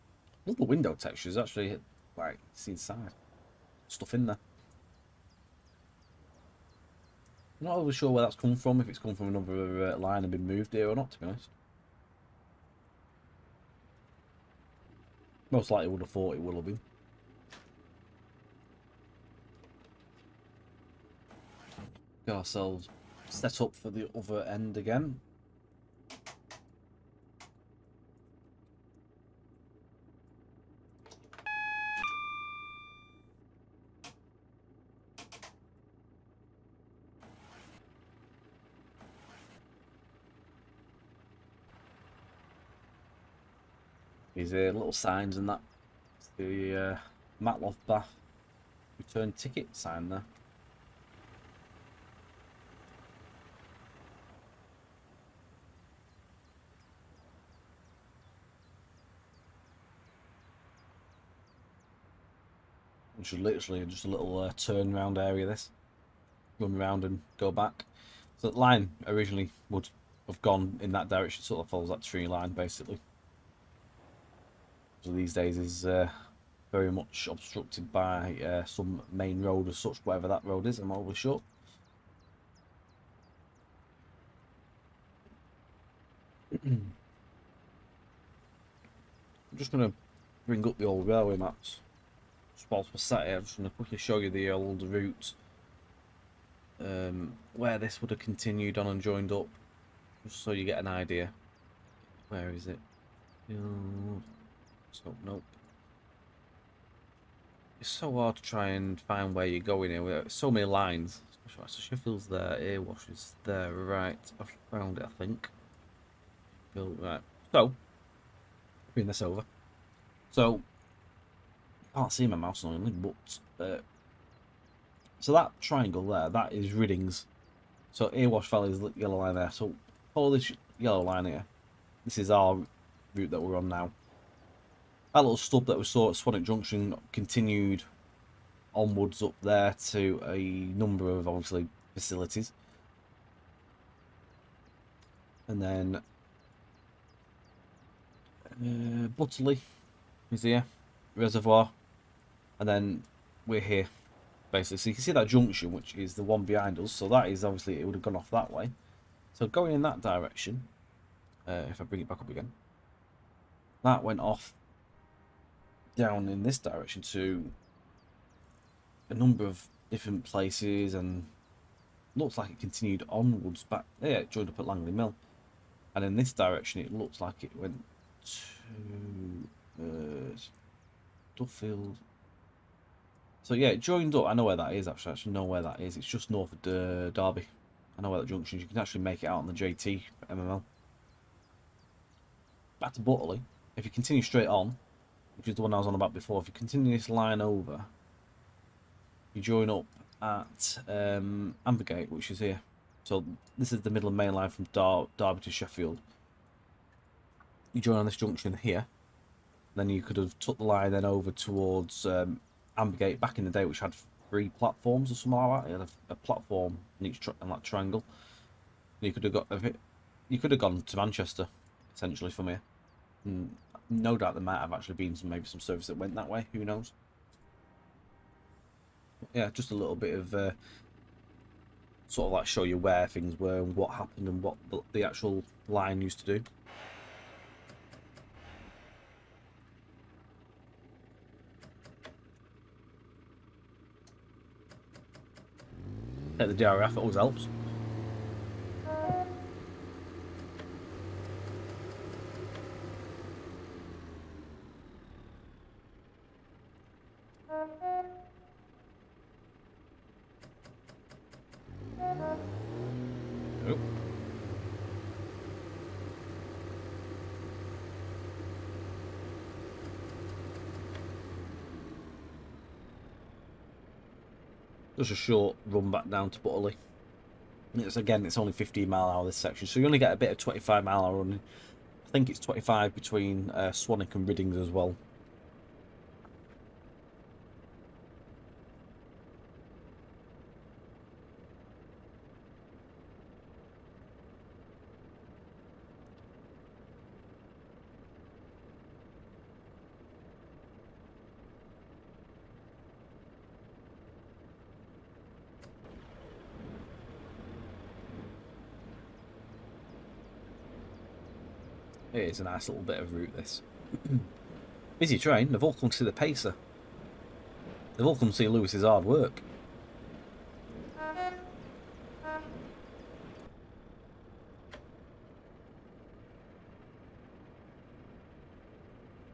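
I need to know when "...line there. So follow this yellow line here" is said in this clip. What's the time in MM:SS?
02:09.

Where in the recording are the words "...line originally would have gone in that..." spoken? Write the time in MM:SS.
01:08.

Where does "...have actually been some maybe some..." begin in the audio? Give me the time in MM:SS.
03:44.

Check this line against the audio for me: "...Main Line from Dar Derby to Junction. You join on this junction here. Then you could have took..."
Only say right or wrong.
wrong.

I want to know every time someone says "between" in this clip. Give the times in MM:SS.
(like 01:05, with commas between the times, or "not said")
04:42.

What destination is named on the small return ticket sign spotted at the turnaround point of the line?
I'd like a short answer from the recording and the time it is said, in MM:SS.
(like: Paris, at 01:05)
Matlock Bath, at 00:47.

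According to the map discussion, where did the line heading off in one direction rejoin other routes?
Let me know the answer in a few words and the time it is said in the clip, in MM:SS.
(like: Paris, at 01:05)
Langley Mill, at 02:54.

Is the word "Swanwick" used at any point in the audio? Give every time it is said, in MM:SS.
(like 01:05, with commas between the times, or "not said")
02:16, 04:43.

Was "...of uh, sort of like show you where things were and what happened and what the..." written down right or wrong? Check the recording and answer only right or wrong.
right.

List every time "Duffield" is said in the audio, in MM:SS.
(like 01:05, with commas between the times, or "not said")
03:01.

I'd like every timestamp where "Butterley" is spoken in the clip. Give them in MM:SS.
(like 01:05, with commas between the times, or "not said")
02:29, 03:13, 04:36.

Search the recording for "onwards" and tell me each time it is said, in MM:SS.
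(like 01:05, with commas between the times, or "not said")
02:18, 02:53.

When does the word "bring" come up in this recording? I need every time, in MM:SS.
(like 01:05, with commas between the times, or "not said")
01:30, 01:58, 02:41.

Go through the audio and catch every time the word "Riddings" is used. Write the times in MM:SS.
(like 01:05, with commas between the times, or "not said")
02:06, 04:44.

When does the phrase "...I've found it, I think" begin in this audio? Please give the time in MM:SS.
01:54.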